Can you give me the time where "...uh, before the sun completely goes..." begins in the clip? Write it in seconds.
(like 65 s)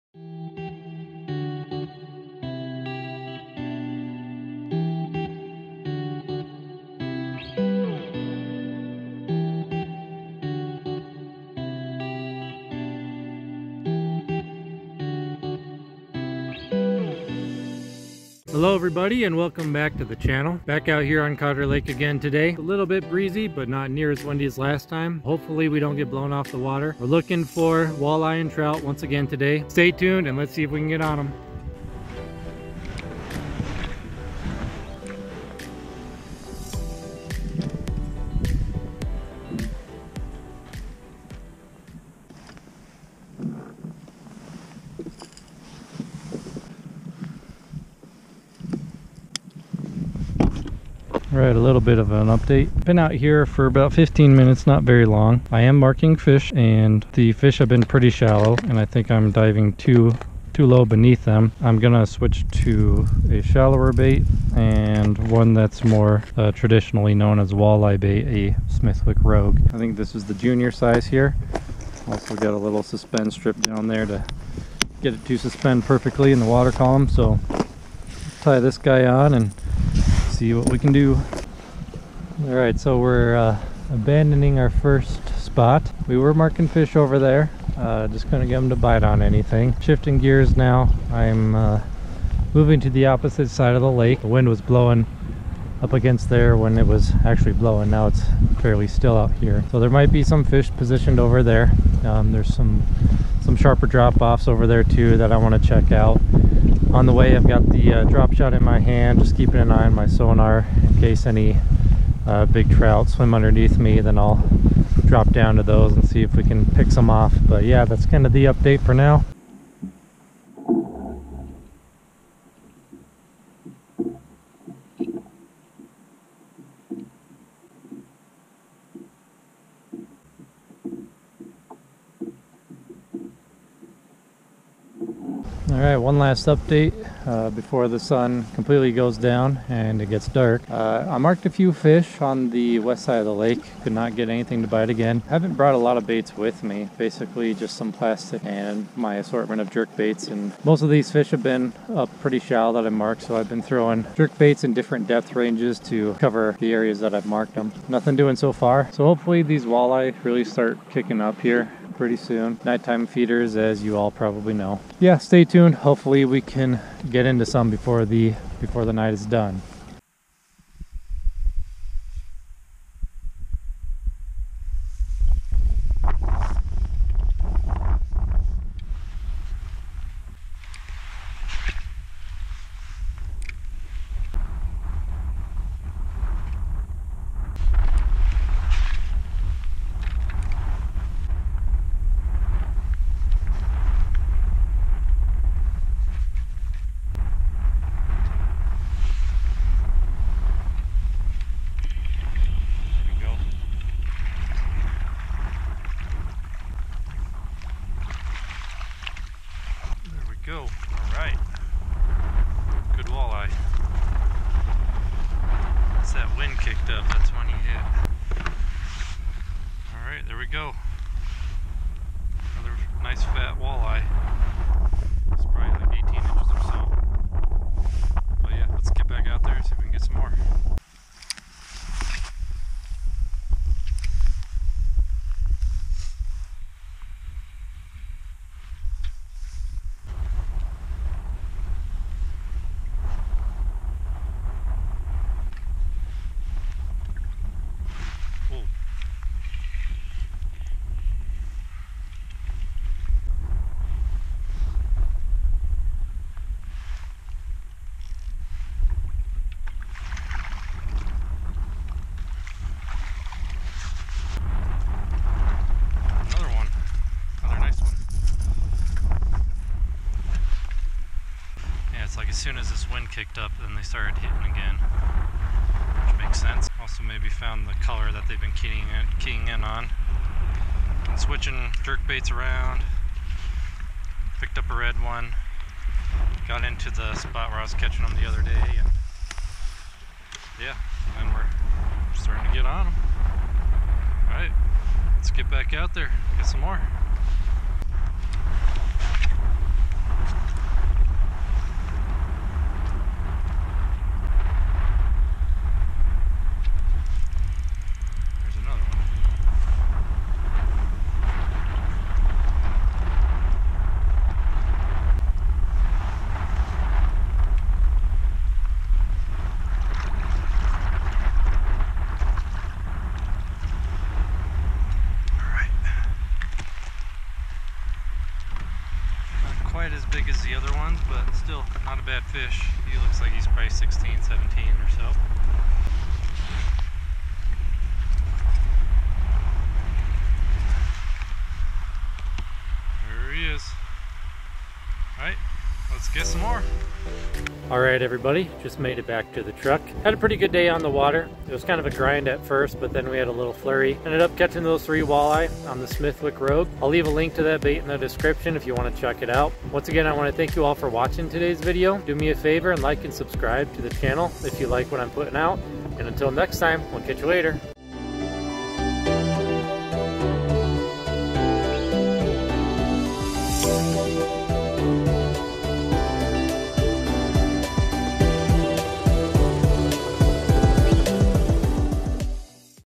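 137 s.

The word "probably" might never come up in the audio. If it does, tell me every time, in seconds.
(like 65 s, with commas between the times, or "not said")
164 s, 333 s.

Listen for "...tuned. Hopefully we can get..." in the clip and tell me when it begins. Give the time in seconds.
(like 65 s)
165 s.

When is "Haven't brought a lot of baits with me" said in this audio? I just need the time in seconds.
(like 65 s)
145 s.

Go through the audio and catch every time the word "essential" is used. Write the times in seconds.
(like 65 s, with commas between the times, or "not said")
not said.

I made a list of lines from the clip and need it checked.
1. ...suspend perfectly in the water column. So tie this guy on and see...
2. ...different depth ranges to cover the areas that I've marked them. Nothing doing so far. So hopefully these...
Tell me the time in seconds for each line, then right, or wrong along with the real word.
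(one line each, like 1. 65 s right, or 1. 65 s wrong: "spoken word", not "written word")
1. 75 s right
2. 154 s right.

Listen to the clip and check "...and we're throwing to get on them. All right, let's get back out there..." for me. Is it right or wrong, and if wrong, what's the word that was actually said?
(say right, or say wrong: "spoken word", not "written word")
wrong: "starting", not "throwing".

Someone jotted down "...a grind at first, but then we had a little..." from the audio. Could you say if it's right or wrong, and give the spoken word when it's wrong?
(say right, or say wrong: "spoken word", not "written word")
right.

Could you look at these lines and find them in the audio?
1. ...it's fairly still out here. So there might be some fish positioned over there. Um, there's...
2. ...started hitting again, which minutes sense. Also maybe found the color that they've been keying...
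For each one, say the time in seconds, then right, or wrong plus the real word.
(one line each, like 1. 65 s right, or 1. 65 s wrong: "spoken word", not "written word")
1. 98 s right
2. 273 s wrong: "makes", not "minutes".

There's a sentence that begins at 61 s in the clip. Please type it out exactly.
I'm gonna switch to a shallower bait and one that's more uh, traditionally known as walleye bait, a Smithwick Rogue.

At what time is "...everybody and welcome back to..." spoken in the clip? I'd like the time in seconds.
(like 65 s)
18 s.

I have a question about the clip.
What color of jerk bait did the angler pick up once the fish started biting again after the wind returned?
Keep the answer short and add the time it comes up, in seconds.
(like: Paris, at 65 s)
red, at 284 s.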